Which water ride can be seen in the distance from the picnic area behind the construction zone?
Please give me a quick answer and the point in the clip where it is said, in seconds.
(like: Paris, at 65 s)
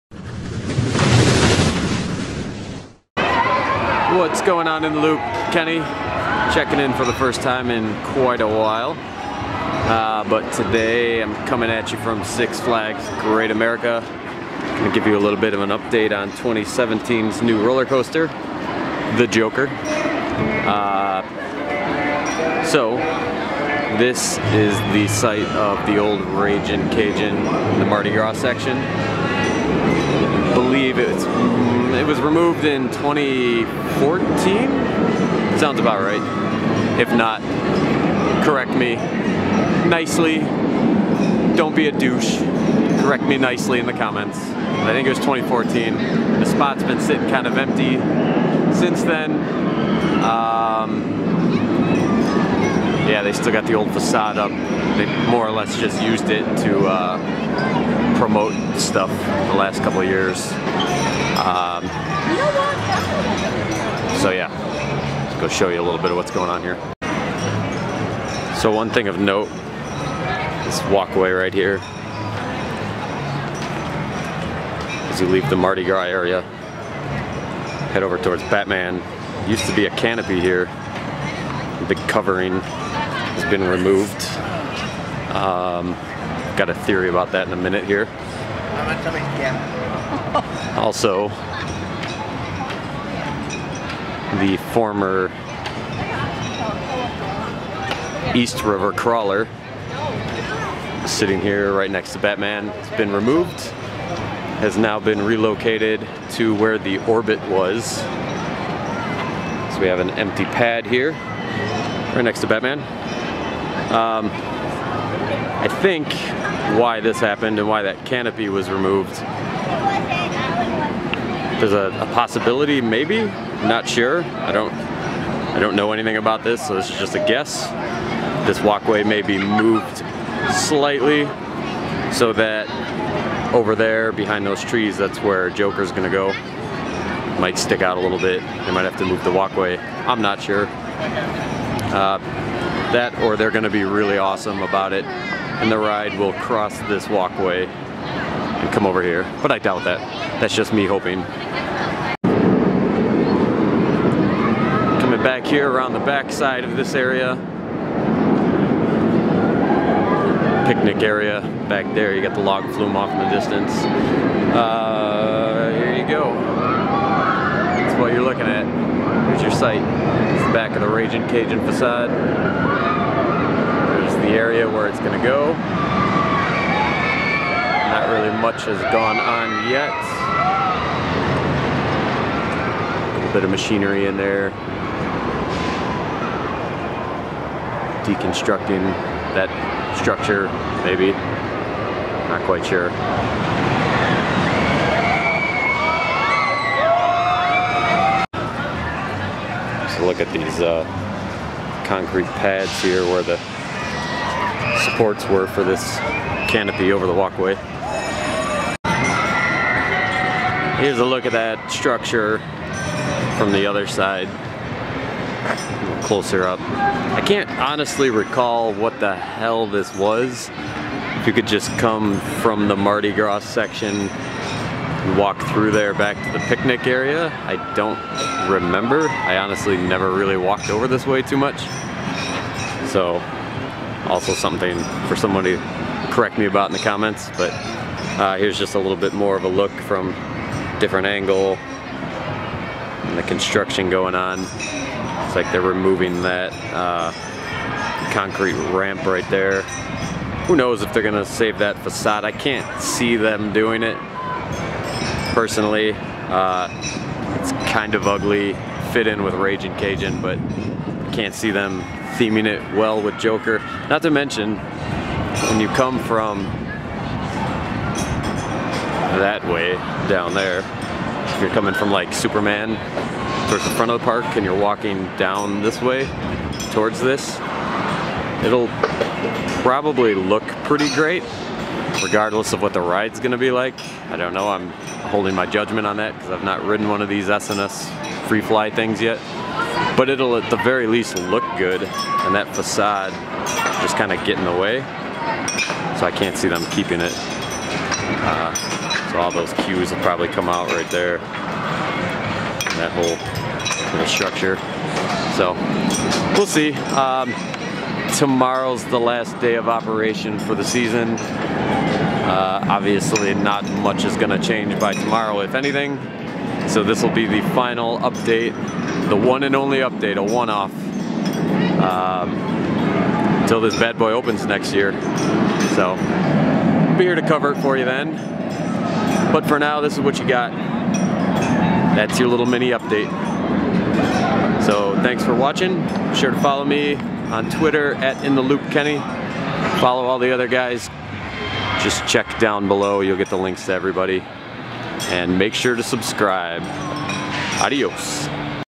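log flume, at 162 s.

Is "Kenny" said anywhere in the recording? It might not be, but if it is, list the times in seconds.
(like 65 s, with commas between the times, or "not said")
5 s, 338 s.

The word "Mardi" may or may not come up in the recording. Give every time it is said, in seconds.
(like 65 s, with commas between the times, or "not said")
27 s, 75 s, 222 s.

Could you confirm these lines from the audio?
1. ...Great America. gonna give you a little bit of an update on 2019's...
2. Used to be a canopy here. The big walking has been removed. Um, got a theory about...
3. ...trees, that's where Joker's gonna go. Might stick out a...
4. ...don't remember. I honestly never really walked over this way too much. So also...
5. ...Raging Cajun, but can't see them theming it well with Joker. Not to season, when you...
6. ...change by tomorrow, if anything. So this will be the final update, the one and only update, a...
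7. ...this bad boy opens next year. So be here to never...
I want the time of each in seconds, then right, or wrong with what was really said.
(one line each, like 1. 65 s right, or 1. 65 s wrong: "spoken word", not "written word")
1. 13 s wrong: "2017", not "2019"
2. 79 s wrong: "covering", not "walking"
3. 134 s right
4. 227 s right
5. 259 s wrong: "mention", not "season"
6. 314 s right
7. 323 s wrong: "cover", not "never".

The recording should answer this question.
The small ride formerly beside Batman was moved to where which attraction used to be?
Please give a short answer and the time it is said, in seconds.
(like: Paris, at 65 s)
the Orbit, at 106 s.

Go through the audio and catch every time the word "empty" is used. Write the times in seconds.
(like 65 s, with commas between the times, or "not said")
47 s, 110 s.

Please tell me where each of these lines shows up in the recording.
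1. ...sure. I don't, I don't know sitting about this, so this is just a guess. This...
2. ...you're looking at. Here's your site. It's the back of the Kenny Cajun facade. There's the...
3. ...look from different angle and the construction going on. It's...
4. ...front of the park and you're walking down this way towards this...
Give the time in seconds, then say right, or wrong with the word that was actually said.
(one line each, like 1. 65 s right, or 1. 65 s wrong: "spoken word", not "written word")
1. 123 s wrong: "anything", not "sitting"
2. 168 s wrong: "Raging", not "Kenny"
3. 239 s right
4. 273 s right.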